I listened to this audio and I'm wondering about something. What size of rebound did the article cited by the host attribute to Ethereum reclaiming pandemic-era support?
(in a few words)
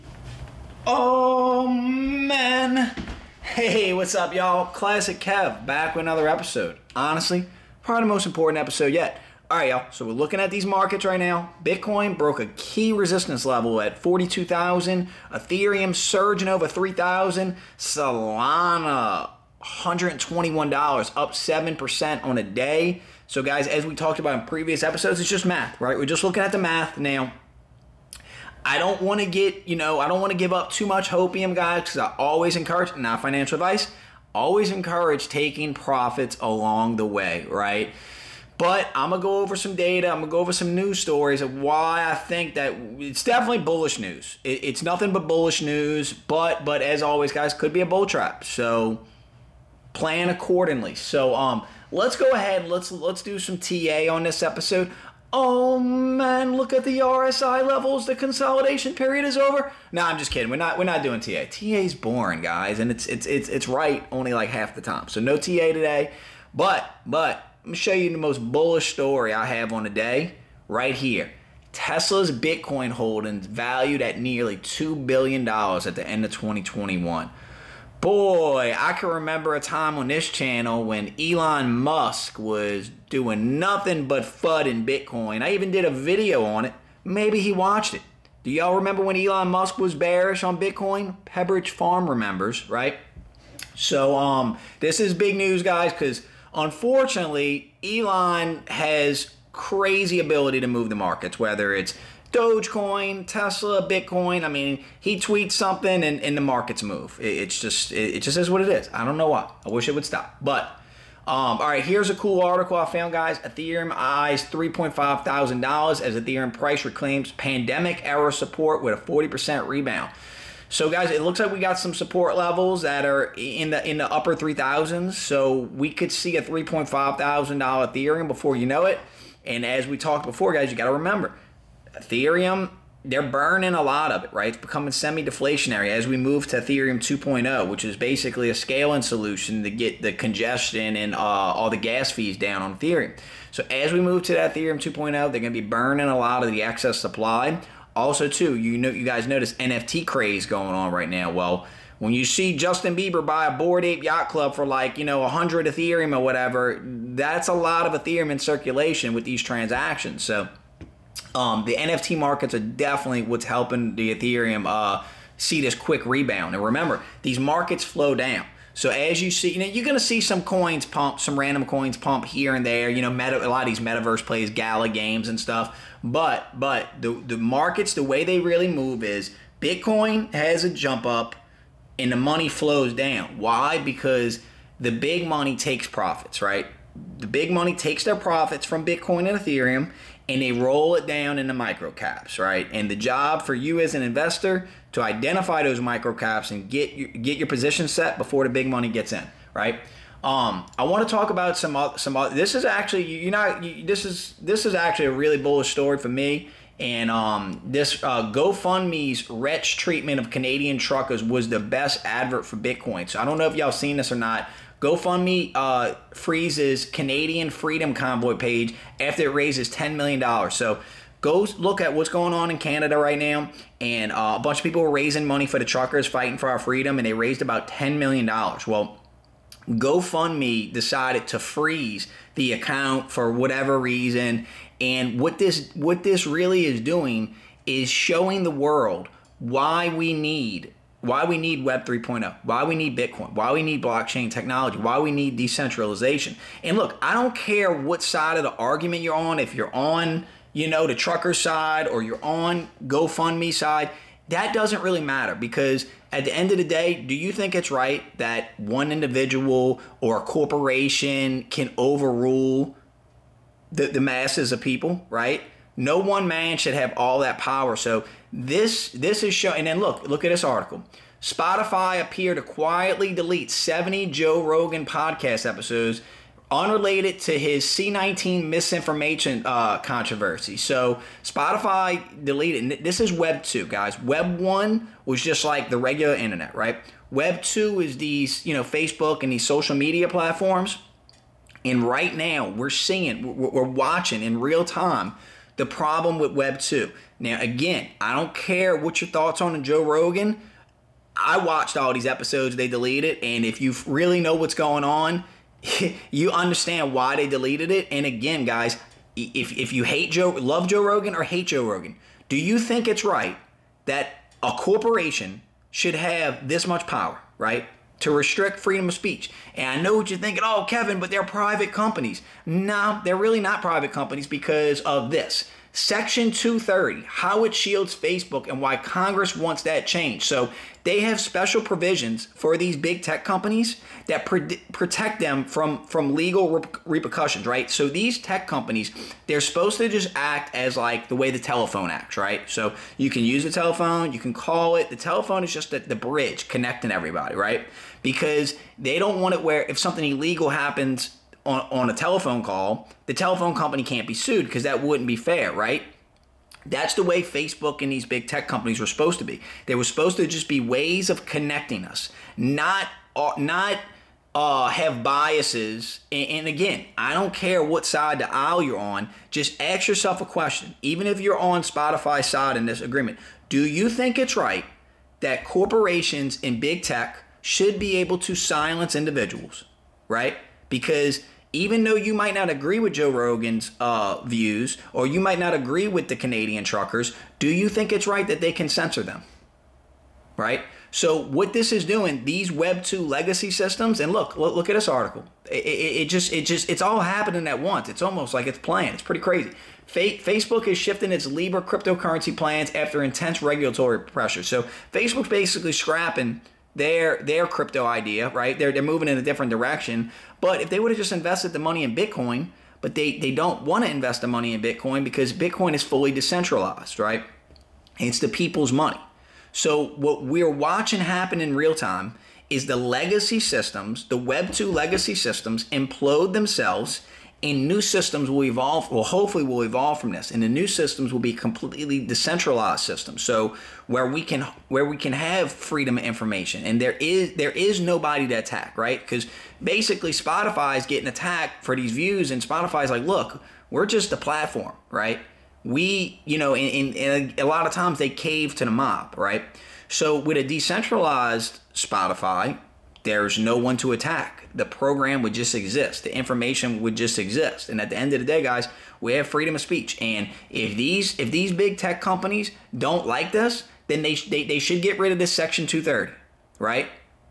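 40%.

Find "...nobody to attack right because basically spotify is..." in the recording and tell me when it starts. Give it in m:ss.
7:17.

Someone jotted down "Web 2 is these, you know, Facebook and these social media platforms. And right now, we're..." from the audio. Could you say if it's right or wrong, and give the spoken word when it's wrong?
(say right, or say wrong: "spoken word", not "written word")
right.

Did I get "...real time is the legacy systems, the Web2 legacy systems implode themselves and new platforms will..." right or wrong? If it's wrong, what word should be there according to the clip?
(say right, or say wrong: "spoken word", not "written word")
wrong: "systems", not "platforms".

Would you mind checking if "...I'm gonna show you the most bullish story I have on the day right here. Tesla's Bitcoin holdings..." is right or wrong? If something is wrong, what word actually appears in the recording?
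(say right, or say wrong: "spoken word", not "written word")
right.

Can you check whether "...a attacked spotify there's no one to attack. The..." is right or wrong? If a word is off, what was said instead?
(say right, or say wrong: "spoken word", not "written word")
wrong: "decentralized", not "attacked".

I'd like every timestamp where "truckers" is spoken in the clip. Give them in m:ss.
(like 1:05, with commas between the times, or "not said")
3:30, 3:45, 4:10, 6:26.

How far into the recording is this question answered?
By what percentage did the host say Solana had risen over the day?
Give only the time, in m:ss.
0:21.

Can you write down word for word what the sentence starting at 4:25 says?
No one man should have all that power.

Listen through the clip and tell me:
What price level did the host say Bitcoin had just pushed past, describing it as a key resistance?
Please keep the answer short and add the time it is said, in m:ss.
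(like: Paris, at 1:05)
42,000, at 0:13.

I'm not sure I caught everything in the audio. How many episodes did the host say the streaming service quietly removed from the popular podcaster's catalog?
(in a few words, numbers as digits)
70.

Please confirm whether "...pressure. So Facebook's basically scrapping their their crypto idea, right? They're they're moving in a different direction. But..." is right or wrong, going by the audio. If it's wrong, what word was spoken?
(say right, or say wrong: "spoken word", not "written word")
right.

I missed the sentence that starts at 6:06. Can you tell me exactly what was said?
And, and again, I don't care what side the aisle you're on.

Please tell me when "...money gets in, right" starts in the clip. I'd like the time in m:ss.
3:18.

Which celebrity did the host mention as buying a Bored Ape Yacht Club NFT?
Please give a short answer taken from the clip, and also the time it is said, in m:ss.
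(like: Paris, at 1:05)
Justin Bieber, at 2:32.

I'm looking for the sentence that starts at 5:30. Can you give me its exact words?
So they have special provisions for these big tech companies that pre- protect them from, from legal re- repercussions, right?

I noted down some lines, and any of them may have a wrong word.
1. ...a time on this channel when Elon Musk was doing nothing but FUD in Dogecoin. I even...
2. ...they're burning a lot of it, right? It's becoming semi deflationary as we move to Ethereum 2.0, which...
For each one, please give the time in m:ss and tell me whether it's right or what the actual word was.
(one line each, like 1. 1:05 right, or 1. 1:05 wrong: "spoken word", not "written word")
1. 1:19 wrong: "Bitcoin", not "Dogecoin"
2. 2:13 right.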